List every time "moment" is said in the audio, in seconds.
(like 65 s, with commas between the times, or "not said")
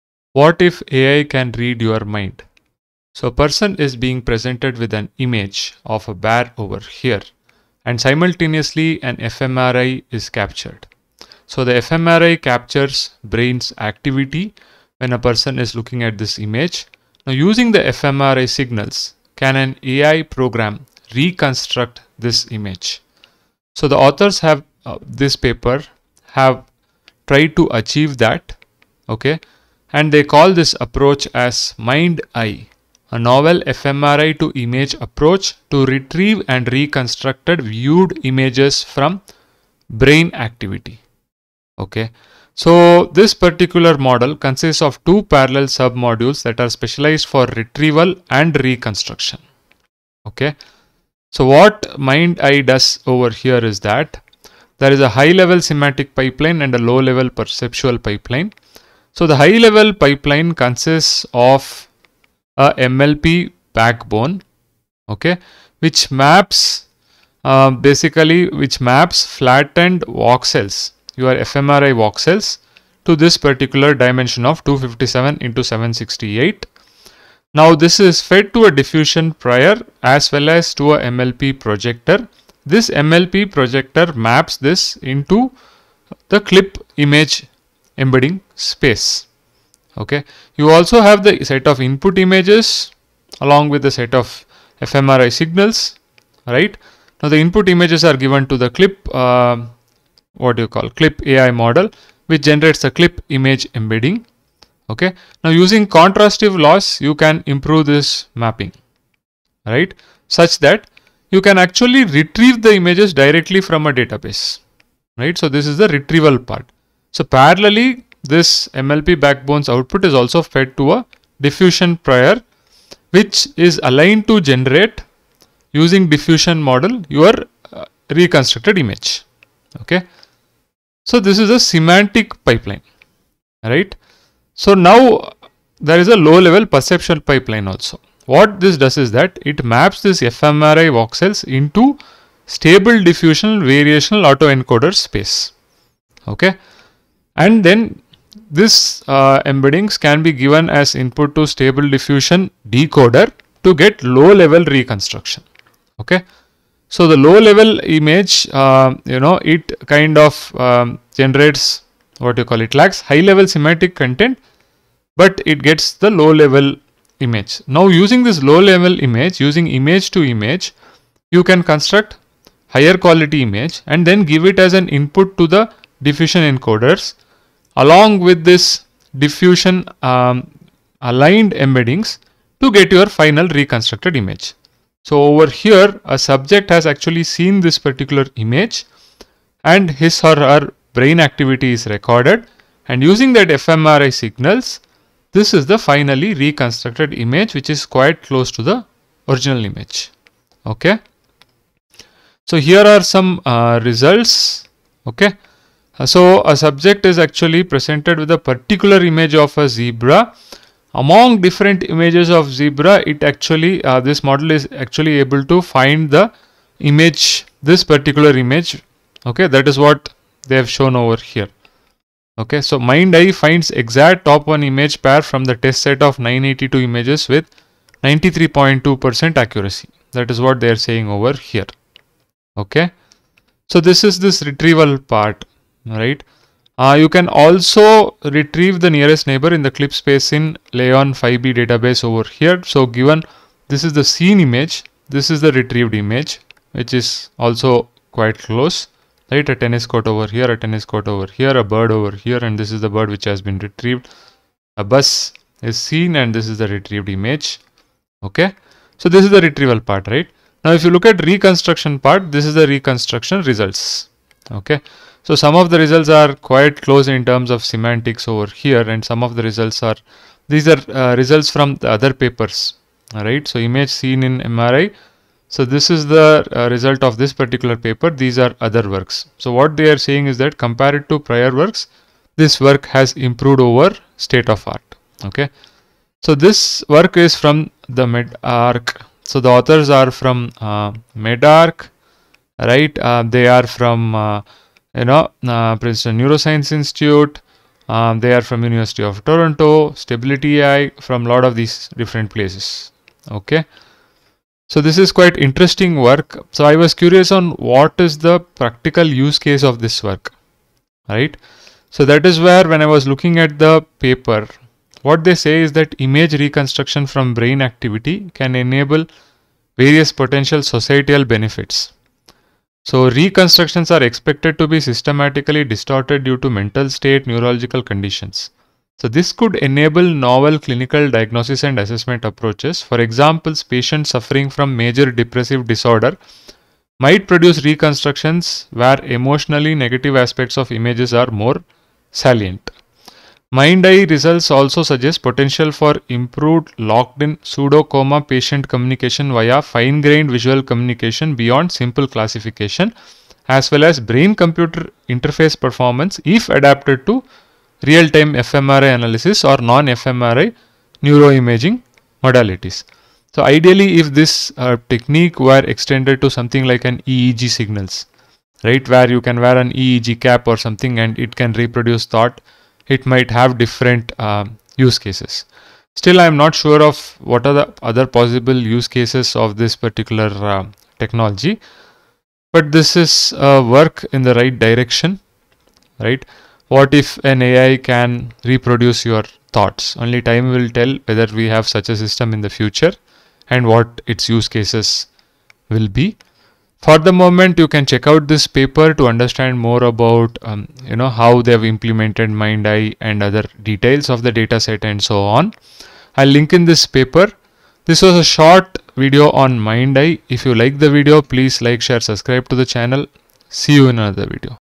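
397 s.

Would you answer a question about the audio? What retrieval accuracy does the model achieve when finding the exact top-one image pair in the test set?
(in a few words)
93.2 percent.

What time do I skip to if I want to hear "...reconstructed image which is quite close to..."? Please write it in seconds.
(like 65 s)
196 s.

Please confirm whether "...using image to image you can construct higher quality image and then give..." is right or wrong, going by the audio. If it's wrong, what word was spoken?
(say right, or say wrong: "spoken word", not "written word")
right.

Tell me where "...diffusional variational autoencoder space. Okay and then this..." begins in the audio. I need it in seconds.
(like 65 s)
142 s.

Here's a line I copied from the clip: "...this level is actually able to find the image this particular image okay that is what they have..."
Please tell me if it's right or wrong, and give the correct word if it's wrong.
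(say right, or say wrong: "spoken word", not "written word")
wrong: "model", not "level".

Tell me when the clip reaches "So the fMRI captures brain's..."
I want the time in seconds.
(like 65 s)
11 s.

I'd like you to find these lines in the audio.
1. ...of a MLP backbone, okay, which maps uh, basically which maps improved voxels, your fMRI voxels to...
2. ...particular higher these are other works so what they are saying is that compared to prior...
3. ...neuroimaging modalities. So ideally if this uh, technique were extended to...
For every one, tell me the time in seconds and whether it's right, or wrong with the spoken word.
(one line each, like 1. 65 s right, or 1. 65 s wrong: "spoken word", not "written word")
1. 61 s wrong: "flattened", not "improved"
2. 277 s wrong: "paper", not "higher"
3. 361 s right.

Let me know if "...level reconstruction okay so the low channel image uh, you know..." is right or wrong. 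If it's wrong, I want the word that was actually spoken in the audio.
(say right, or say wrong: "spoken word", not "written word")
wrong: "level", not "channel".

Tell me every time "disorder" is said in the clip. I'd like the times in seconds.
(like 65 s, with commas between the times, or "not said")
335 s.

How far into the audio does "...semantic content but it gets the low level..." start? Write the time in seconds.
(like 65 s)
163 s.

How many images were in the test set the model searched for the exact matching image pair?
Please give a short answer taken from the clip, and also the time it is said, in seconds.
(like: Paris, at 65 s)
982, at 226 s.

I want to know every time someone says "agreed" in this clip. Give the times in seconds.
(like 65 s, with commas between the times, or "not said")
not said.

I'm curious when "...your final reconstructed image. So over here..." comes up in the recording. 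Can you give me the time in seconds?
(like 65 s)
182 s.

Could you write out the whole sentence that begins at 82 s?
This MLP projector maps this into the CLIP image embedding space.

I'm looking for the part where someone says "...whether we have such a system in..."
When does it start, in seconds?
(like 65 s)
391 s.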